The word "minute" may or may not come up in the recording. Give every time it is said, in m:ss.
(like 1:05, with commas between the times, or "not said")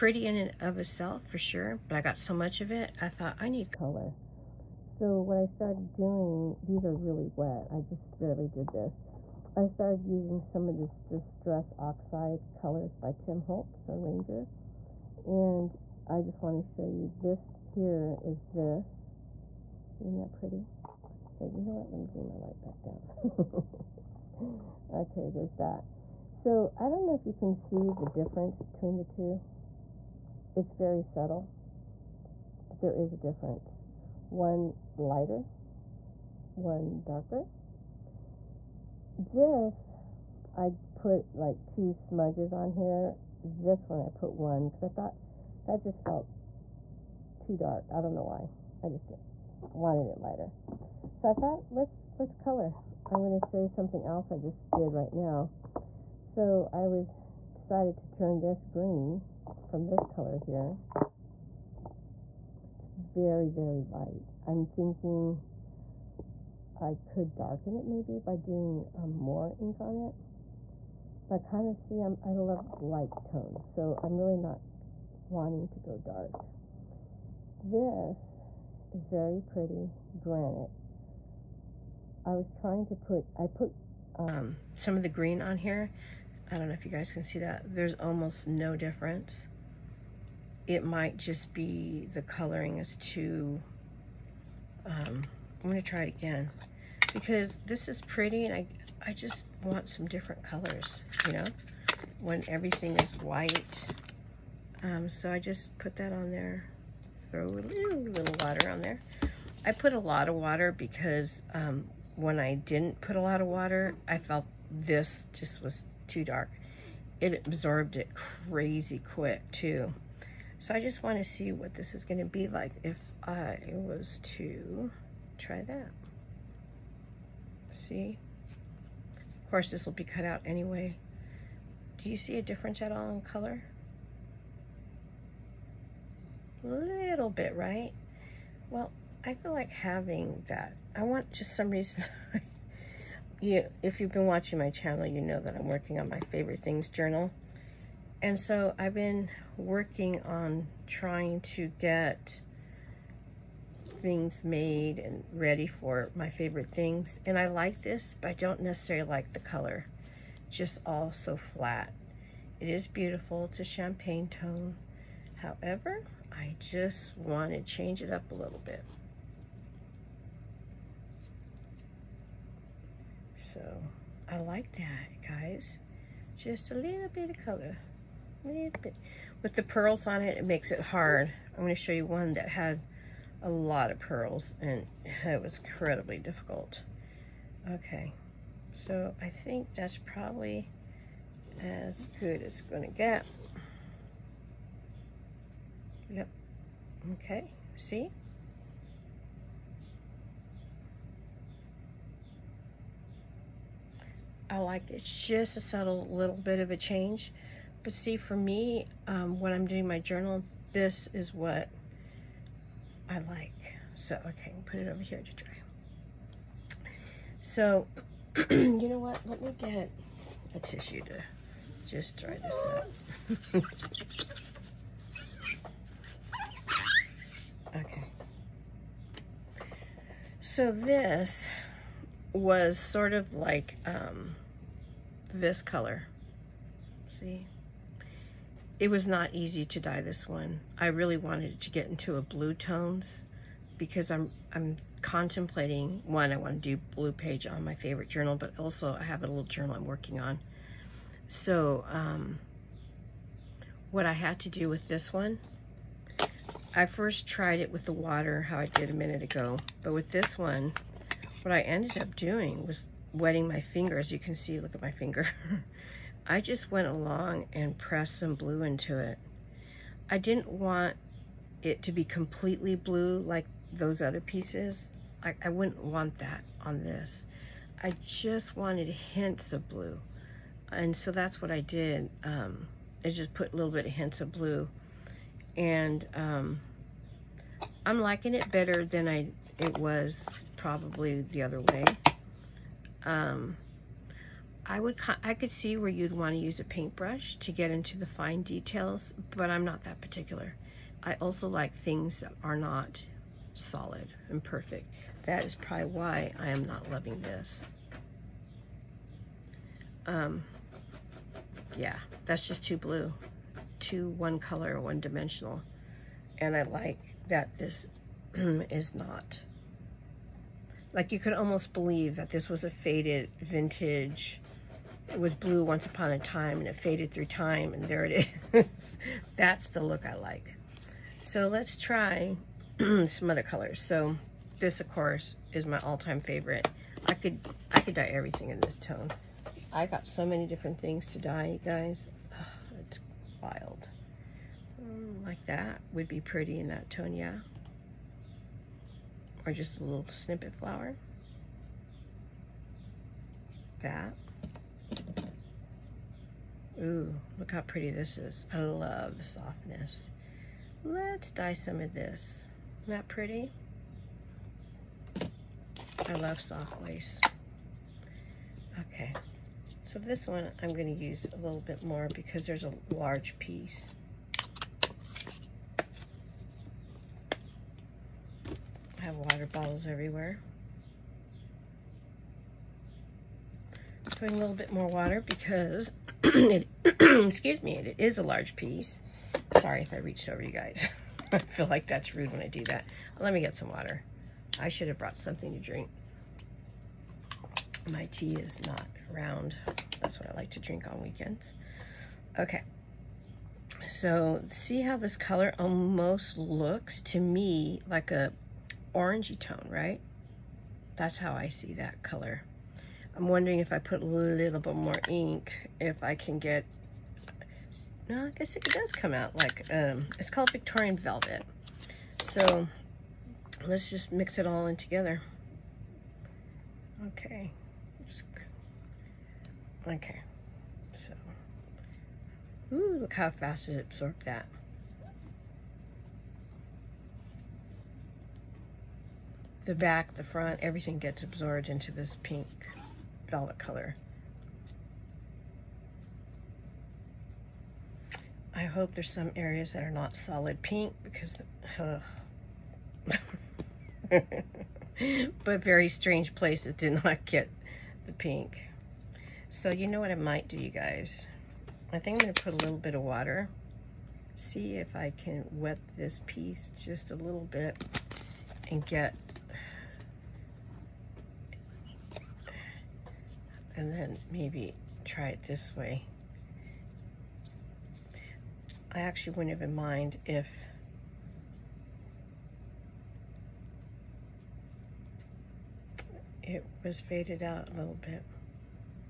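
4:18.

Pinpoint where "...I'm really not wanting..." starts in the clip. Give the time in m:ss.
1:14.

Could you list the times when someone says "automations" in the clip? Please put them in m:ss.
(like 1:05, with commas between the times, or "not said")
not said.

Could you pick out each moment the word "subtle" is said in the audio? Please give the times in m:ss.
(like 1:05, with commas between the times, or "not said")
0:31, 3:25.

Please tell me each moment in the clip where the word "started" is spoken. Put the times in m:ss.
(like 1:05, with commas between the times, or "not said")
0:05, 0:09.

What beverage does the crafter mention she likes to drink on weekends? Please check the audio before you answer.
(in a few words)
tea.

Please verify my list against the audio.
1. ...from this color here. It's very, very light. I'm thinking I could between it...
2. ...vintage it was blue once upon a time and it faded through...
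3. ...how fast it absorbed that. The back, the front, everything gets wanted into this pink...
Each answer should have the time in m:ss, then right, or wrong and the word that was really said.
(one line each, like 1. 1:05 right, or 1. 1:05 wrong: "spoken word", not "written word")
1. 0:59 wrong: "darken", not "between"
2. 5:23 right
3. 7:13 wrong: "absorbed", not "wanted".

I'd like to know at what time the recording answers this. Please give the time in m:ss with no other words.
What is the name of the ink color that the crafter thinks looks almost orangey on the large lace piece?
7:00.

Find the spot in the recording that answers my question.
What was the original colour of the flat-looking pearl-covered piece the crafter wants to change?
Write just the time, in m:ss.
2:43.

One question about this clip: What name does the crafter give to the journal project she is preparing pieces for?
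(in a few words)
favorite things journal.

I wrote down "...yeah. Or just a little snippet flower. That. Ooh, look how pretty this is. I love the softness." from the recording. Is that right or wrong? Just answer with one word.
right.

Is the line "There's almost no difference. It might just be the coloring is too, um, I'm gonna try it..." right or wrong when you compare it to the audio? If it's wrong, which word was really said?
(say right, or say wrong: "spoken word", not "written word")
right.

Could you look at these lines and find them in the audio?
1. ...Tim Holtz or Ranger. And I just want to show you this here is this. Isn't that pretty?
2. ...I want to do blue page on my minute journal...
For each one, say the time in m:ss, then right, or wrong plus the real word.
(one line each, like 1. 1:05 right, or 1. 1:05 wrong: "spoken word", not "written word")
1. 0:13 right
2. 4:06 wrong: "favorite", not "minute".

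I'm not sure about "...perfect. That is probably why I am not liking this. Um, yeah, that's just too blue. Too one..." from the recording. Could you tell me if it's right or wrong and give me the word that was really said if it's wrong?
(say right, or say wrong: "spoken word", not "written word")
wrong: "loving", not "liking".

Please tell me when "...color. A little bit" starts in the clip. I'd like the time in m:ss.
2:57.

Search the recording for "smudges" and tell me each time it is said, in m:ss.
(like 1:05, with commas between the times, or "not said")
0:41.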